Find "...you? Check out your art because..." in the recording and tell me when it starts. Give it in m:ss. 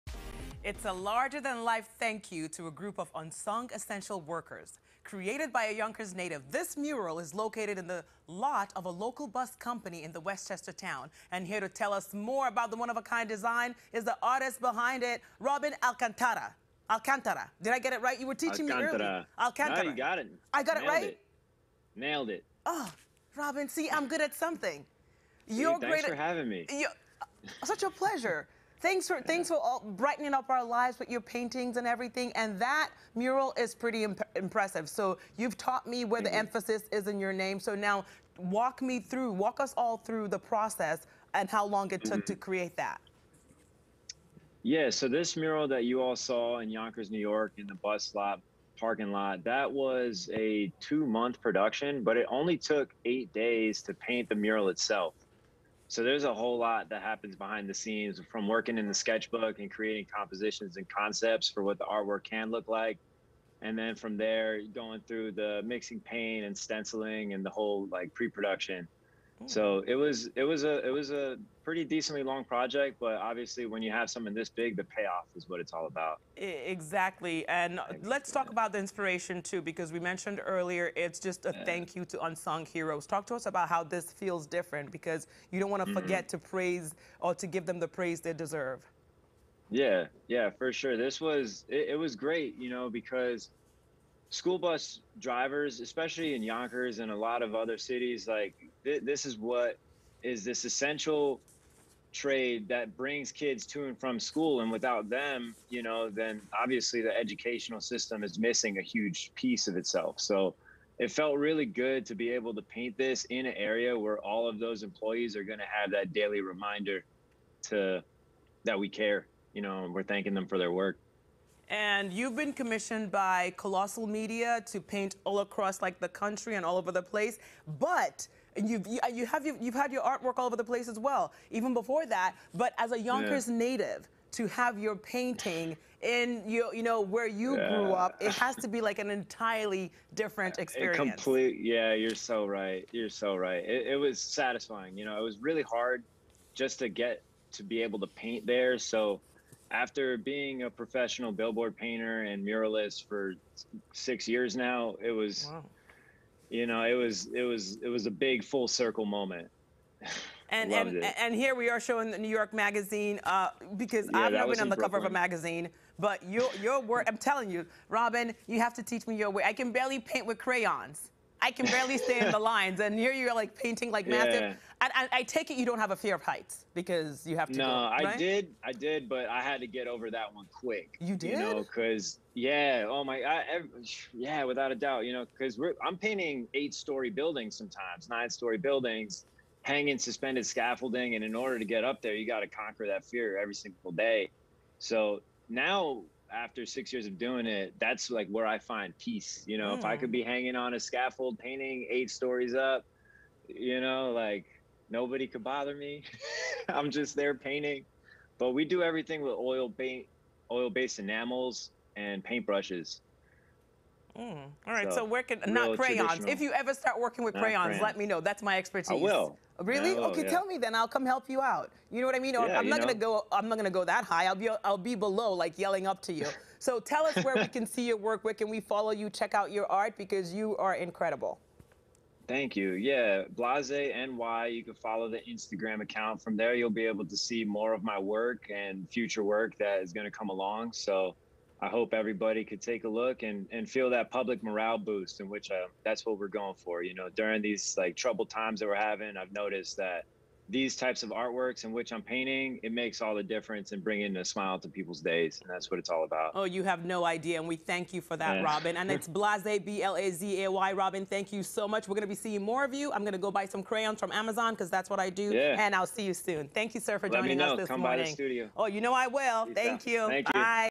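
3:48.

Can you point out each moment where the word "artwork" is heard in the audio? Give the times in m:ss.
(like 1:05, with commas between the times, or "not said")
1:01, 2:10, 4:11.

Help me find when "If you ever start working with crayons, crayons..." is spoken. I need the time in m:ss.
3:36.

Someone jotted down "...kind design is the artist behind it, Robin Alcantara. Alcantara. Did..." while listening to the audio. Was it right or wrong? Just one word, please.
right.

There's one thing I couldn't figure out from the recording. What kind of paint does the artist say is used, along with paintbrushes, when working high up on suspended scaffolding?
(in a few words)
oil based enamels.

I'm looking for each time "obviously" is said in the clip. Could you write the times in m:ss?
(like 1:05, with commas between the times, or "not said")
1:13, 1:46.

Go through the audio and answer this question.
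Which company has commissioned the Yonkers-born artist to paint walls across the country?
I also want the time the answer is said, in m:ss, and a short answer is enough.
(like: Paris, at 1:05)
Colossal Media, at 2:03.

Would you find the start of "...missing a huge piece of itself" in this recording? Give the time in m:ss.
1:48.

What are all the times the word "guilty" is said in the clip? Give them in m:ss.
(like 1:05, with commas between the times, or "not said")
not said.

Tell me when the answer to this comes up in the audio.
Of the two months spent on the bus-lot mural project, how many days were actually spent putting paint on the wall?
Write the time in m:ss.
0:53.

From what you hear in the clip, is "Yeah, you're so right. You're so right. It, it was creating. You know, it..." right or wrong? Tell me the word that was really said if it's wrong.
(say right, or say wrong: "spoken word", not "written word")
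wrong: "satisfying", not "creating".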